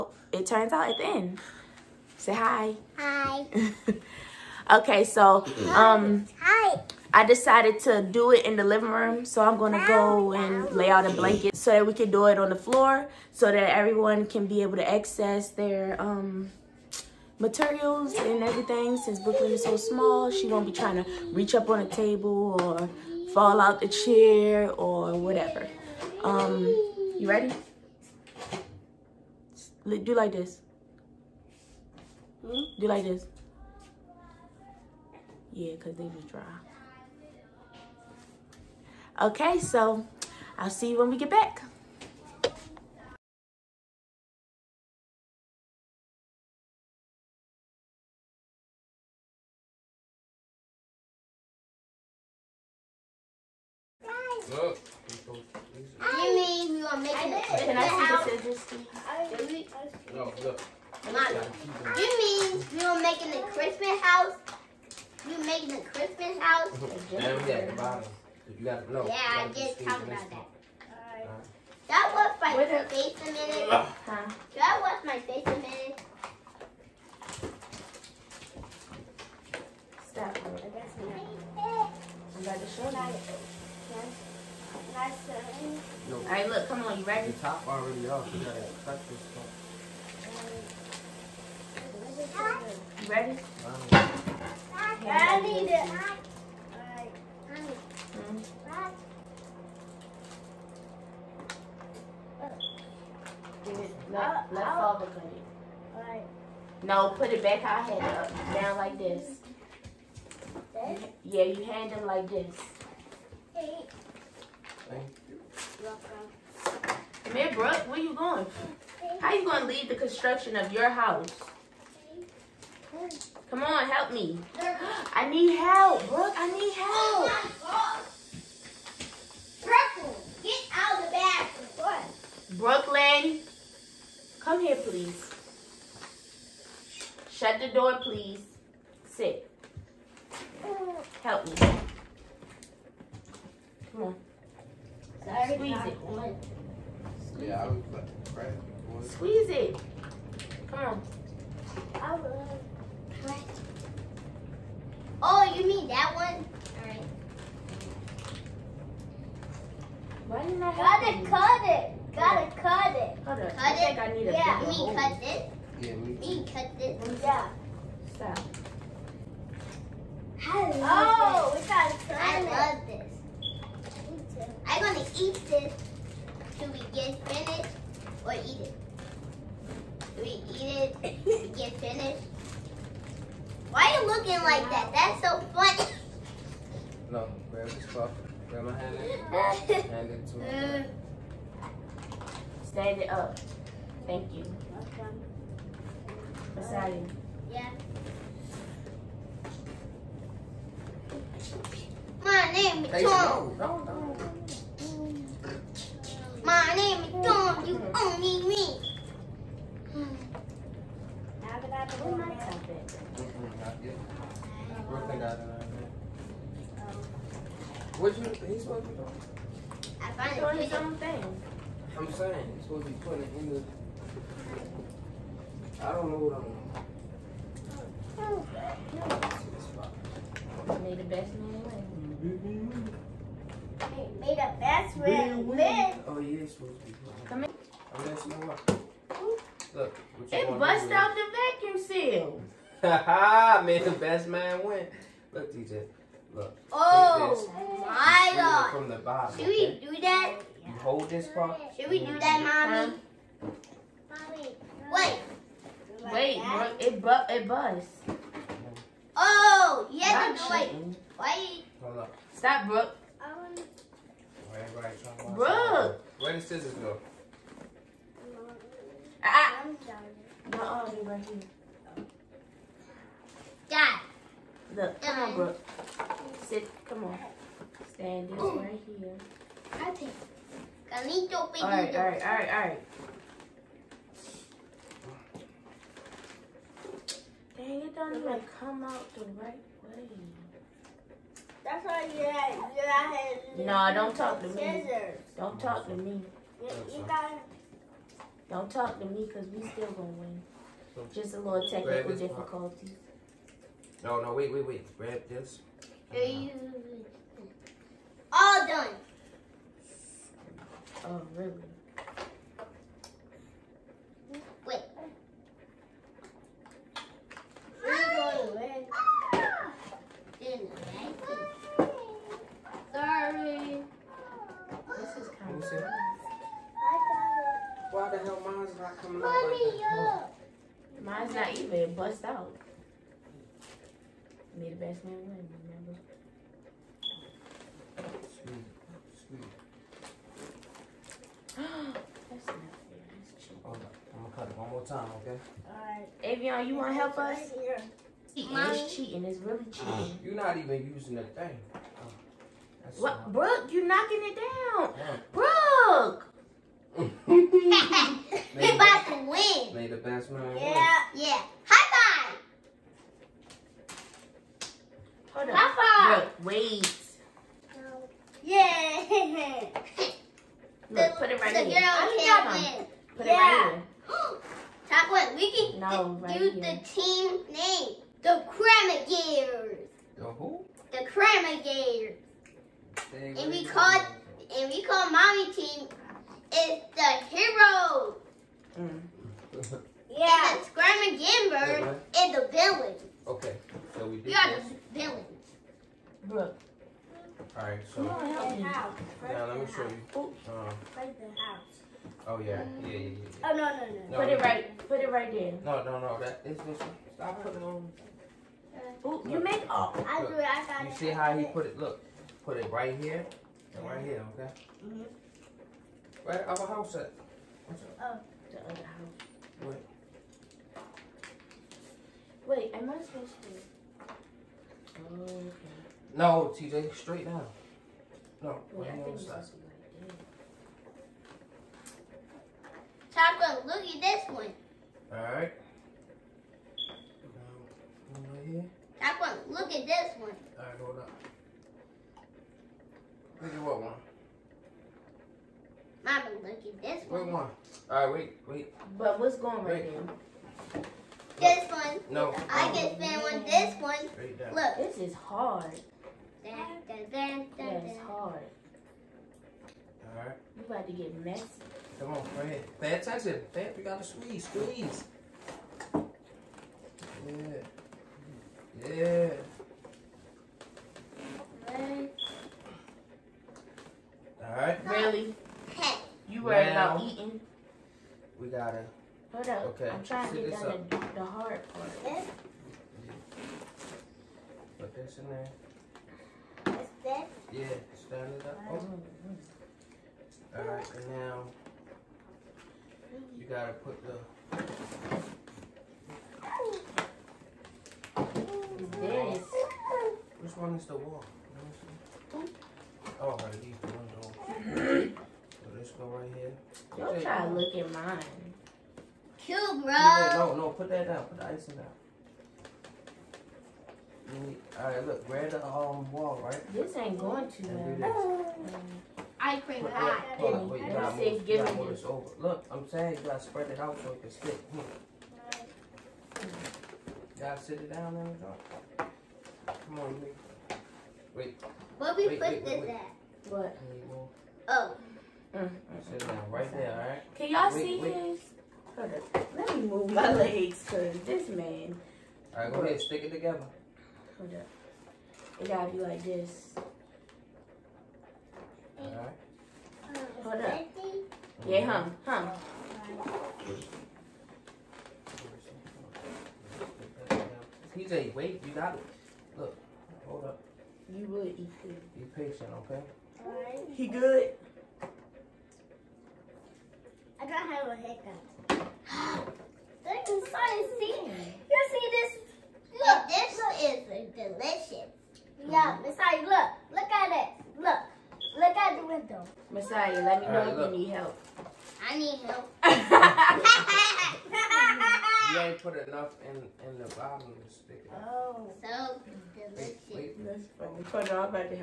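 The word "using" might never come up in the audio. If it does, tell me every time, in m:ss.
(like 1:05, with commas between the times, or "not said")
5:50.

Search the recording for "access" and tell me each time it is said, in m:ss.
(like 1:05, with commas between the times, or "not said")
0:14.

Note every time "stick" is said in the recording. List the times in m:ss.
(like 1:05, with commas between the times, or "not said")
8:44, 9:03, 9:47.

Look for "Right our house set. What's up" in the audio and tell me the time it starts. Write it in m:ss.
6:56.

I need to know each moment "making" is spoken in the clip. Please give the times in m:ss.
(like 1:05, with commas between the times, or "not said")
0:56, 1:03.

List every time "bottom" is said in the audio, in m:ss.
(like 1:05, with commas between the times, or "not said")
1:07, 4:08, 9:47.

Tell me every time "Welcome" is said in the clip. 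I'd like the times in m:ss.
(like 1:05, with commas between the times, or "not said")
1:55, 3:14.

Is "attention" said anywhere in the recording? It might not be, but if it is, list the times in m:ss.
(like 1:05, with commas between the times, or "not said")
7:42.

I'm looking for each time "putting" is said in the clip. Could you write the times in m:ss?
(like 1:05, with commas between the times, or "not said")
3:42.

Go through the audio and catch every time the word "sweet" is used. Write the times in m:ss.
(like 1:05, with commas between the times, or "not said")
5:39.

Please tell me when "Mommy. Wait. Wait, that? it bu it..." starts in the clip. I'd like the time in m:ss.
4:14.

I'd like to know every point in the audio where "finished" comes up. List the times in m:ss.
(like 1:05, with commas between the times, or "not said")
2:57, 3:01.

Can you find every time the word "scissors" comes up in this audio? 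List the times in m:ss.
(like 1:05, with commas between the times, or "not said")
4:26.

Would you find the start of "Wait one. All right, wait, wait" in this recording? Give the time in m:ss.
7:27.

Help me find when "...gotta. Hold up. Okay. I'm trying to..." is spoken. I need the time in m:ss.
7:58.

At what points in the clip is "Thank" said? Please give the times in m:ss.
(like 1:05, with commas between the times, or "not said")
1:54, 3:14.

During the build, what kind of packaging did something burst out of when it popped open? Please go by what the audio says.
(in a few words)
vacuum seal.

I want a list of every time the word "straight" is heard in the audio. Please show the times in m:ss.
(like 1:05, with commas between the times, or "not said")
7:07.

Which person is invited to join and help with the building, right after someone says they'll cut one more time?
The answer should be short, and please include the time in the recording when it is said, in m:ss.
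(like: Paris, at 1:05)
Avion, at 5:46.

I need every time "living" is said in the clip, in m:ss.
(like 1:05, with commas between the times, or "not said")
0:08.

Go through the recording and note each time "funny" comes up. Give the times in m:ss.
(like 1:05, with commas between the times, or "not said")
3:05, 9:50.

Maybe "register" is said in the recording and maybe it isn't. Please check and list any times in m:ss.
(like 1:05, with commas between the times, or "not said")
not said.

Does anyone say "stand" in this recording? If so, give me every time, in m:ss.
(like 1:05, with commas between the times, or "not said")
3:12, 4:37, 8:07.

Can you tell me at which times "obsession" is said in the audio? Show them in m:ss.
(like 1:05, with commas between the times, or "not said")
not said.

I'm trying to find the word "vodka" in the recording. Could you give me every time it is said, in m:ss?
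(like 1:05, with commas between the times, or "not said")
not said.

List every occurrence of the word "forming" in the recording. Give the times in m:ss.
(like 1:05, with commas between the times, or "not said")
not said.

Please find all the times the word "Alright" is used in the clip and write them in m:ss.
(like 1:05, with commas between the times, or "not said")
5:45, 7:54, 8:10.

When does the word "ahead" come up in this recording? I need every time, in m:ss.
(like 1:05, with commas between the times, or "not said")
7:42, 9:02.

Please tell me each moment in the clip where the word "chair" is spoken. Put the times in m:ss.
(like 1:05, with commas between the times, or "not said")
0:23.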